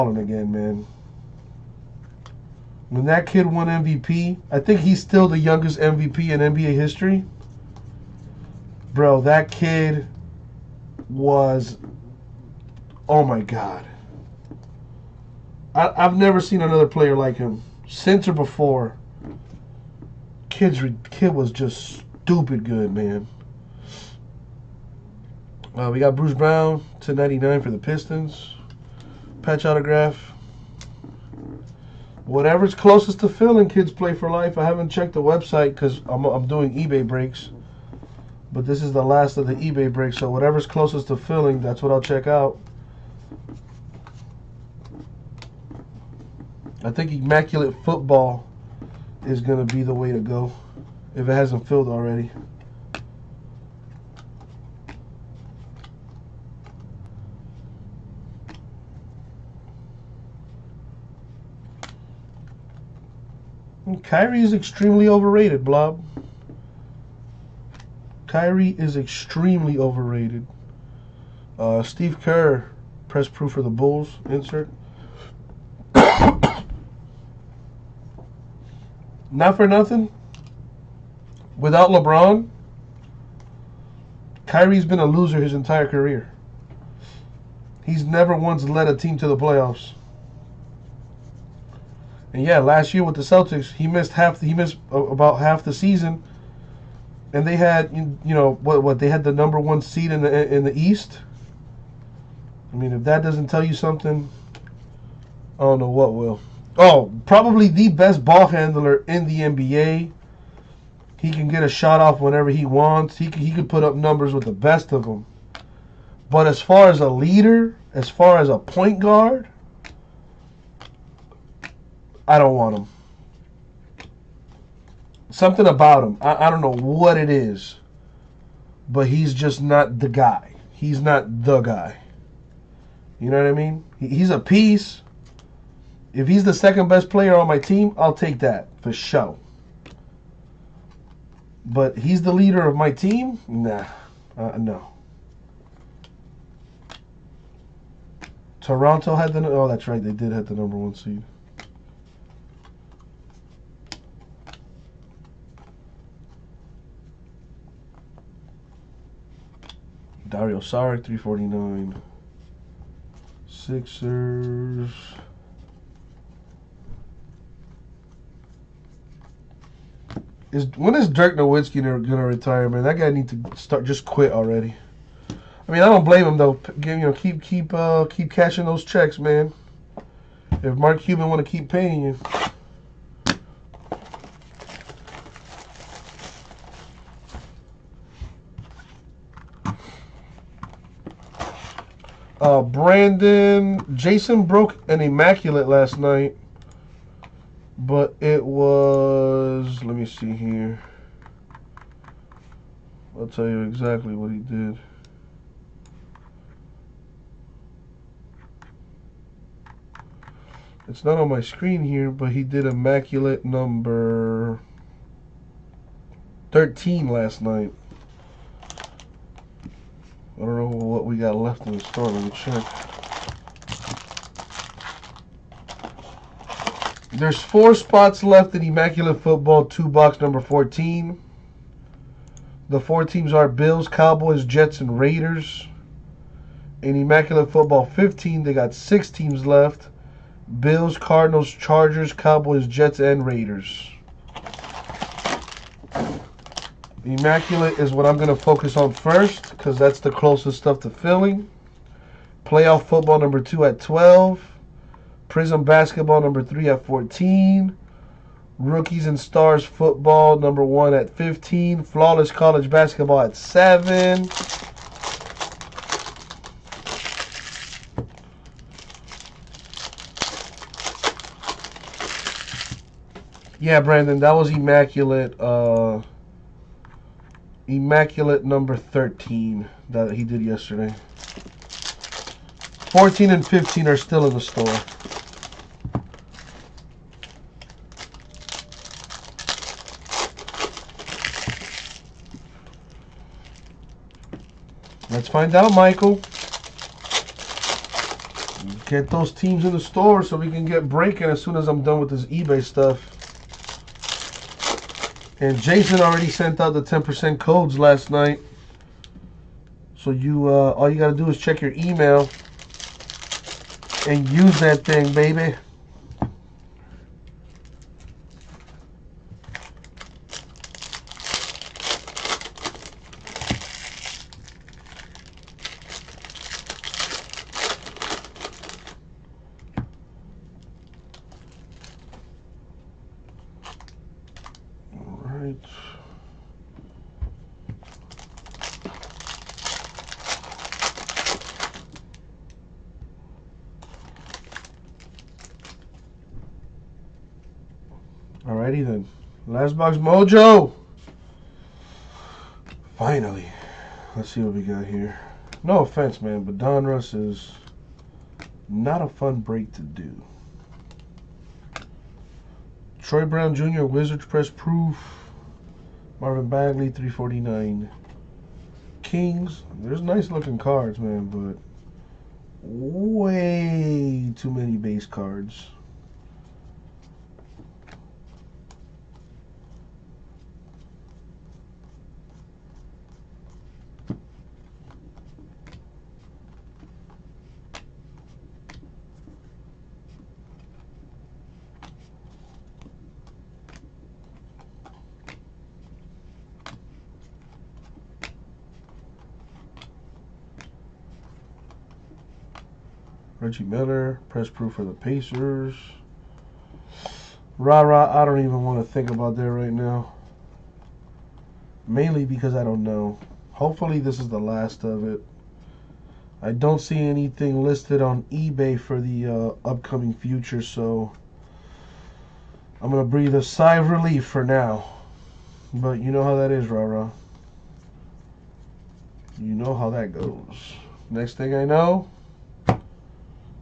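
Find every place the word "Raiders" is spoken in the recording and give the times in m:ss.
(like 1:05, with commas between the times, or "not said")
3:54, 4:03.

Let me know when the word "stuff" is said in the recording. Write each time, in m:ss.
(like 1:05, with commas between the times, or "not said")
4:10, 5:02.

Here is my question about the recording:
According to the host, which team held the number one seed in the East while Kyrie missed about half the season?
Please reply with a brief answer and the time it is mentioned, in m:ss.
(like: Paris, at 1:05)
Toronto, at 2:28.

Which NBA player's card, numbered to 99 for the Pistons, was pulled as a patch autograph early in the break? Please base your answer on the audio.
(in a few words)
Bruce Brown.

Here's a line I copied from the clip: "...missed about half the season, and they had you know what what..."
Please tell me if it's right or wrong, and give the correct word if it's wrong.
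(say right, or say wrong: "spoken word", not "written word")
right.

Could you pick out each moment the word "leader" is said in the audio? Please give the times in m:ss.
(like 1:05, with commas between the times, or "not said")
1:57, 2:22.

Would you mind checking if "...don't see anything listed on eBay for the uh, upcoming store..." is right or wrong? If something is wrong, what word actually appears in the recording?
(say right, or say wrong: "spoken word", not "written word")
wrong: "future", not "store".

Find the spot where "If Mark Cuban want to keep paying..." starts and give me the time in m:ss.
3:00.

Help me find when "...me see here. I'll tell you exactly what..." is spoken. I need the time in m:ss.
3:19.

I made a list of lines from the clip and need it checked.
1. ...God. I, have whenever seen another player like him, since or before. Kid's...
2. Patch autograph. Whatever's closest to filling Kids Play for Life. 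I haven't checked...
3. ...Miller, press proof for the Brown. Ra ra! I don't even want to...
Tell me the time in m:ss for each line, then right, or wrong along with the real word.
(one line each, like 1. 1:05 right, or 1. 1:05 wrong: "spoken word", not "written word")
1. 0:13 wrong: "never", not "whenever"
2. 0:29 right
3. 6:43 wrong: "Pacers", not "Brown".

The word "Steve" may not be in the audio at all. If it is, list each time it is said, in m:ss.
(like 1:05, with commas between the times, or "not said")
1:11.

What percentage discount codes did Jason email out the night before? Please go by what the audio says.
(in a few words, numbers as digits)
10%.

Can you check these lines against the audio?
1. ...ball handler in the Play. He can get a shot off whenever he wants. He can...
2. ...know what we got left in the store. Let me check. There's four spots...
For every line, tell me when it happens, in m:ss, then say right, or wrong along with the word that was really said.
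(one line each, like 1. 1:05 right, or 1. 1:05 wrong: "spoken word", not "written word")
1. 1:48 wrong: "NBA", not "Play"
2. 3:40 right.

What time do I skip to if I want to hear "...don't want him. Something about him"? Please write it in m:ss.
2:02.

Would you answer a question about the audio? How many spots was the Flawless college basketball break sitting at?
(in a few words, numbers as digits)
7.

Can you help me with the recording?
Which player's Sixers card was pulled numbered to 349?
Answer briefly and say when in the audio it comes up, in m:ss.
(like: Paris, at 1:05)
Dario Saric, at 2:40.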